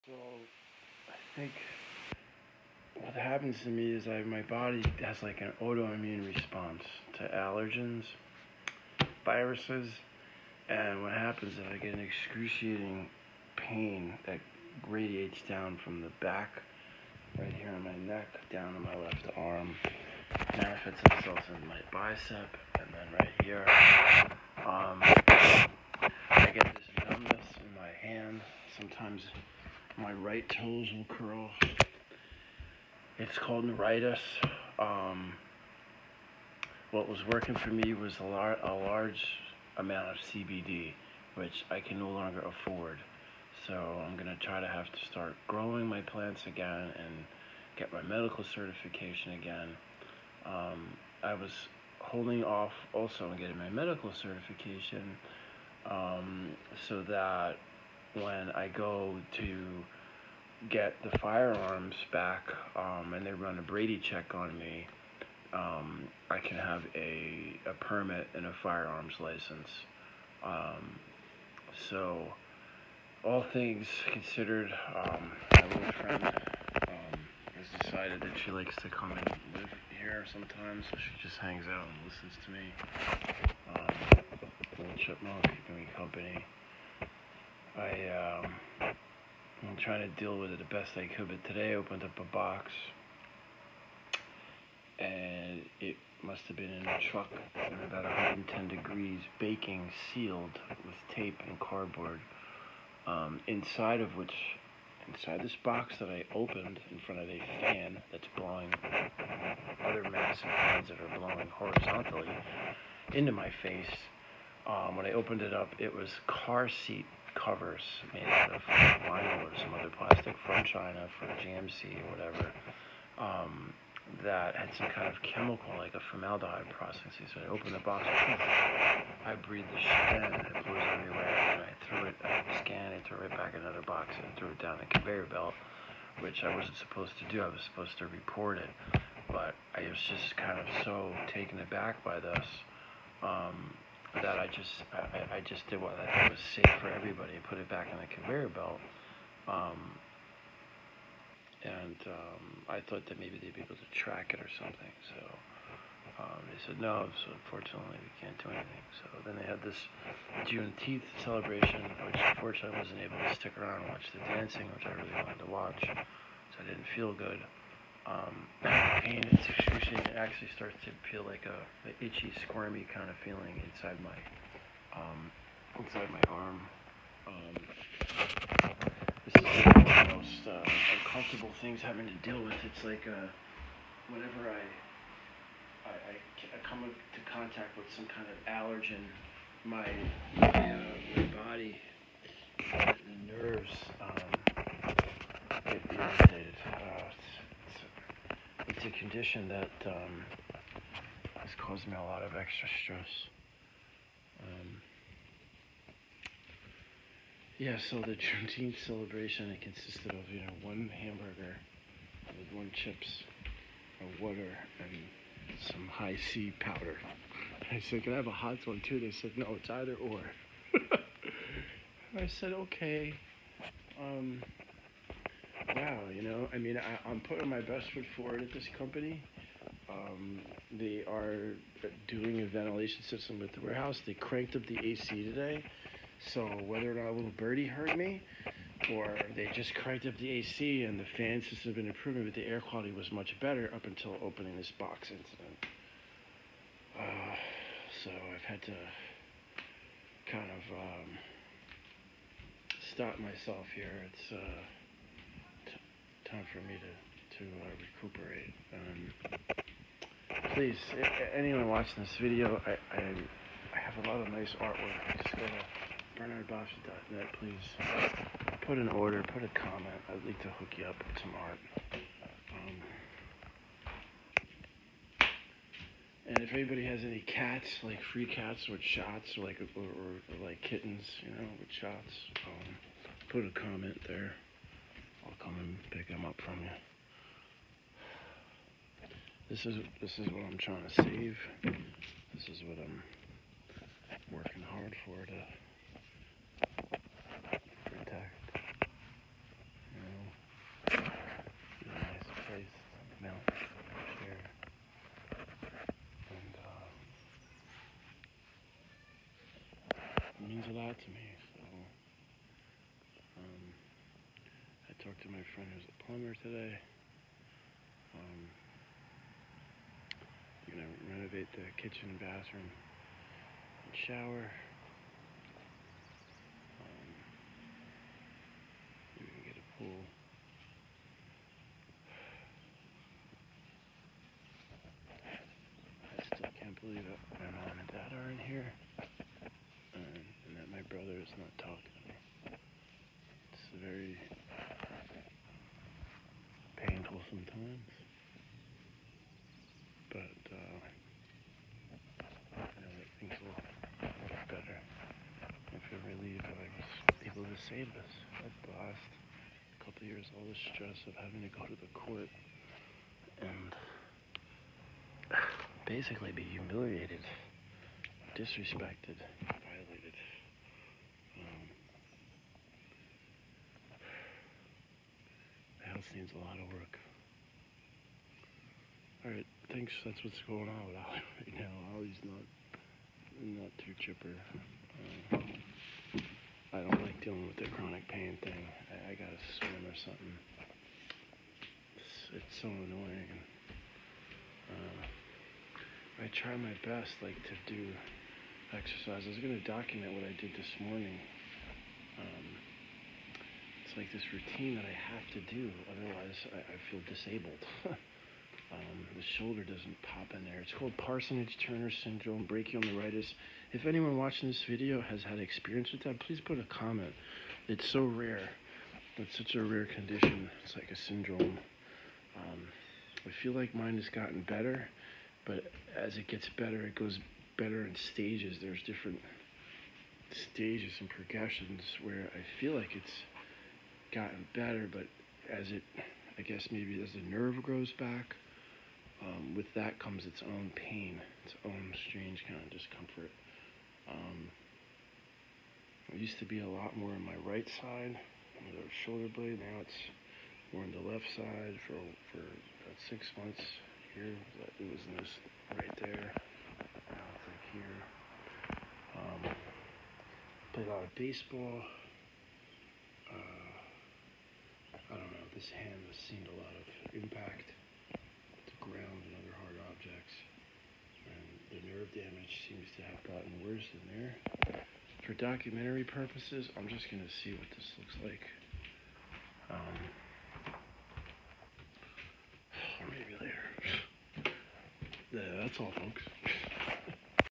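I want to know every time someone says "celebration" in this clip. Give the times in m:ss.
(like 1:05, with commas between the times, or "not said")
2:41, 3:28.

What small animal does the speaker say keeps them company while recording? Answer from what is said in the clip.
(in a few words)
chipmunk.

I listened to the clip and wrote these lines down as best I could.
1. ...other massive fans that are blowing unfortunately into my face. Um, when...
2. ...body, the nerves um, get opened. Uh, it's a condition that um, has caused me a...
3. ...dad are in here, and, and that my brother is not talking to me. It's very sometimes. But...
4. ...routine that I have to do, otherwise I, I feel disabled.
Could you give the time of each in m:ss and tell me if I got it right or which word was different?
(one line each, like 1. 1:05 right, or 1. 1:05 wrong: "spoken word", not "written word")
1. 1:49 wrong: "horizontally", not "unfortunately"
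2. 3:11 wrong: "irritated", not "opened"
3. 5:37 right
4. 6:44 right.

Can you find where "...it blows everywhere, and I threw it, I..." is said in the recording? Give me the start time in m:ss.
2:10.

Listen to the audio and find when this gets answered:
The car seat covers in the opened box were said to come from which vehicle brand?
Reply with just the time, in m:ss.
2:01.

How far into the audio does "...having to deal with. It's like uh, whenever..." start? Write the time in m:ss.
3:01.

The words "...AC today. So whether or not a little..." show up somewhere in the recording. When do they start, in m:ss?
3:54.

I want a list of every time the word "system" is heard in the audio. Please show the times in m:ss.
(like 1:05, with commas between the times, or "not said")
3:53, 4:01.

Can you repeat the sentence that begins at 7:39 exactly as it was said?
Um, played a lot of baseball.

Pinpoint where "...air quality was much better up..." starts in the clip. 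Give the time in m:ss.
4:02.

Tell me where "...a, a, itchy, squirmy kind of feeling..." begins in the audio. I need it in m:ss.
2:51.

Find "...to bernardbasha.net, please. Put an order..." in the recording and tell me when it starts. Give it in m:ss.
4:25.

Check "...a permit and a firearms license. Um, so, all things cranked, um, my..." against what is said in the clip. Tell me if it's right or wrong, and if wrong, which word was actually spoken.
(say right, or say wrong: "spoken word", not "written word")
wrong: "considered", not "cranked".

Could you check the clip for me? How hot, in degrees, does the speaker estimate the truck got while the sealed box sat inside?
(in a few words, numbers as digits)
110.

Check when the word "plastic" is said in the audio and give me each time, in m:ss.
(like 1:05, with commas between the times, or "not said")
1:59.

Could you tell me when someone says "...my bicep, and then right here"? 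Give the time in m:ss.
0:21.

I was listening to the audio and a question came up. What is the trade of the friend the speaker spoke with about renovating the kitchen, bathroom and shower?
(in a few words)
plumber.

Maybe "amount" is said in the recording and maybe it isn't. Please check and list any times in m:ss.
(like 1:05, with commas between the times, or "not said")
0:39.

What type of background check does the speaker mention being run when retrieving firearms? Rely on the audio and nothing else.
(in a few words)
Brady check.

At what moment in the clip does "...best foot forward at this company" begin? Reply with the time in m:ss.
3:47.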